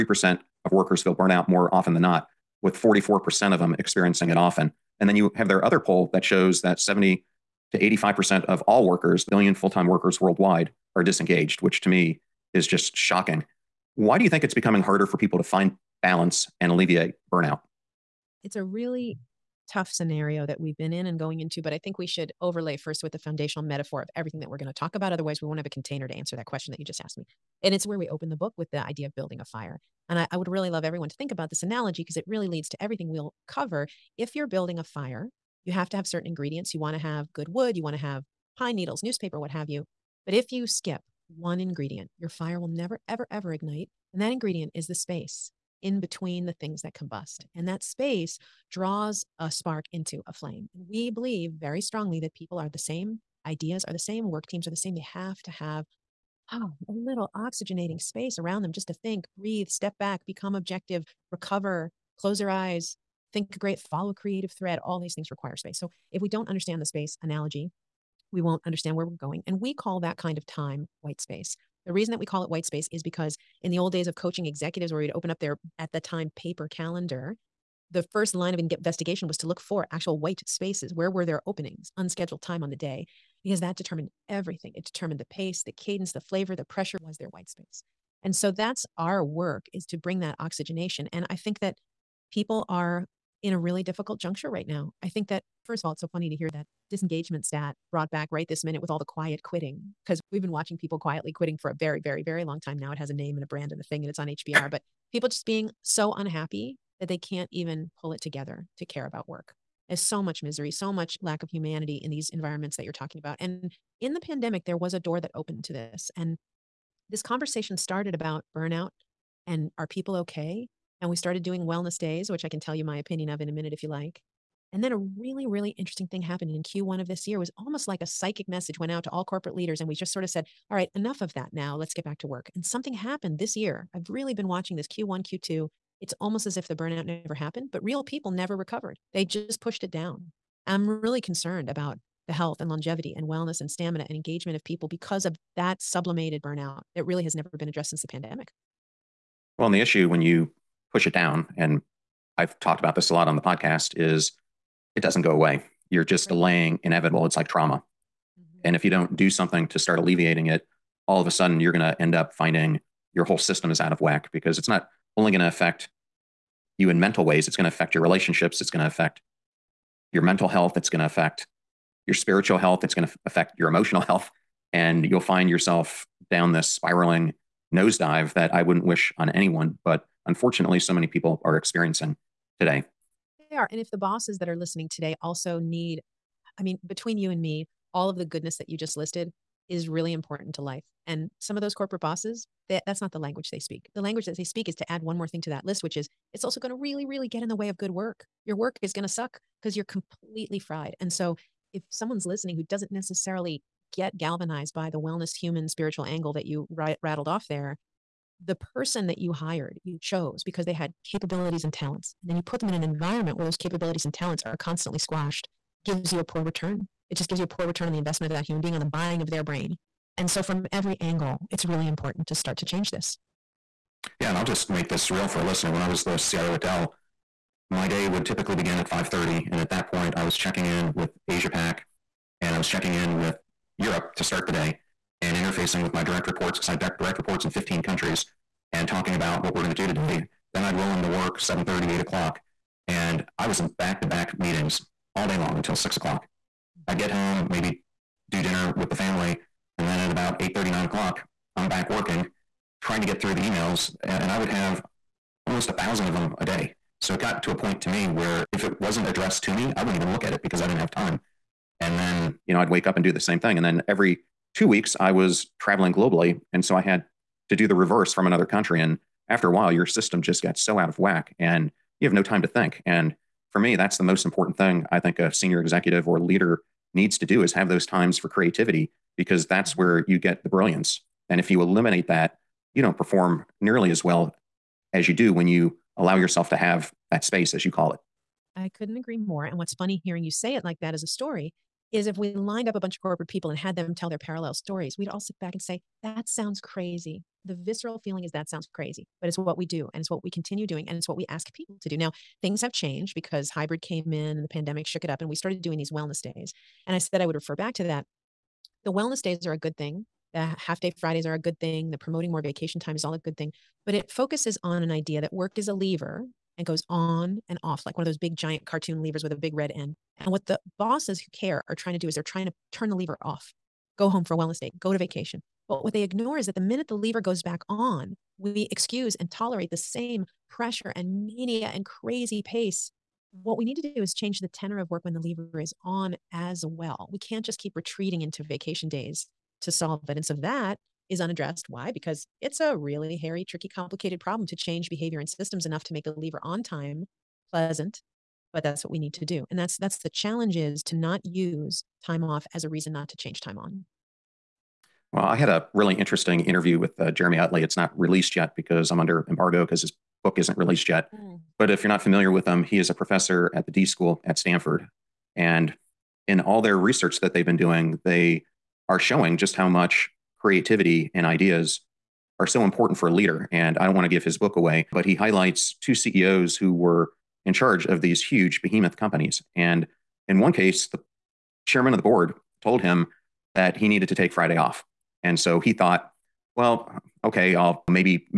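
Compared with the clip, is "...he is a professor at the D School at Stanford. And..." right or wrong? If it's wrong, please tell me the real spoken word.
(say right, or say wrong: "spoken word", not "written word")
right.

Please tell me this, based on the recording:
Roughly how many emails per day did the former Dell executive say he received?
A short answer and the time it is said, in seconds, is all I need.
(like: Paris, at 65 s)
1,000, at 255 s.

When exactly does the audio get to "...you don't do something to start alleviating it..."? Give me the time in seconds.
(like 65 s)
158 s.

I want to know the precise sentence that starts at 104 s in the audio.
But people just being so unhappy that they can't even pull it together to care about work.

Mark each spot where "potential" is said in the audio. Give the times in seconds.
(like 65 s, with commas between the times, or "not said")
not said.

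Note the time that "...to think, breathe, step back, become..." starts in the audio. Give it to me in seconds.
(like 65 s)
58 s.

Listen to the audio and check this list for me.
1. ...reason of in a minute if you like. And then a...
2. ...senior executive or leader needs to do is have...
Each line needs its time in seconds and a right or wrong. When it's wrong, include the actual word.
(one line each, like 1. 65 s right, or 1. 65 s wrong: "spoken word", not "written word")
1. 122 s wrong: "opinion", not "reason"
2. 275 s right.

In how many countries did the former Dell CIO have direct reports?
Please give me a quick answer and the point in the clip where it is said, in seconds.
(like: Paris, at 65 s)
15, at 237 s.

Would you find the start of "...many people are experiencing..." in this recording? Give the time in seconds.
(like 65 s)
180 s.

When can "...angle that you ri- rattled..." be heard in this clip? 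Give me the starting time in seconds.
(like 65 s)
206 s.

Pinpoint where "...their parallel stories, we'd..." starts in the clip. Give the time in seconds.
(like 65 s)
294 s.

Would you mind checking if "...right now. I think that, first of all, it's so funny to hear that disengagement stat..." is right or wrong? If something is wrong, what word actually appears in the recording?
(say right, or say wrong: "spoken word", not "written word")
right.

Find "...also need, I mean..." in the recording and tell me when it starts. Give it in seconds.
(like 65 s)
185 s.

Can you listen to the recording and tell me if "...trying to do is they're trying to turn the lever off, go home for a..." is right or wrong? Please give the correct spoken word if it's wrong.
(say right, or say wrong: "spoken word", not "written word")
right.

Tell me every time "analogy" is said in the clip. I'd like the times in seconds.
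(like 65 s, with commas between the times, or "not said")
31 s, 67 s.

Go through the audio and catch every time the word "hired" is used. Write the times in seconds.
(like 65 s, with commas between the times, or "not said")
209 s.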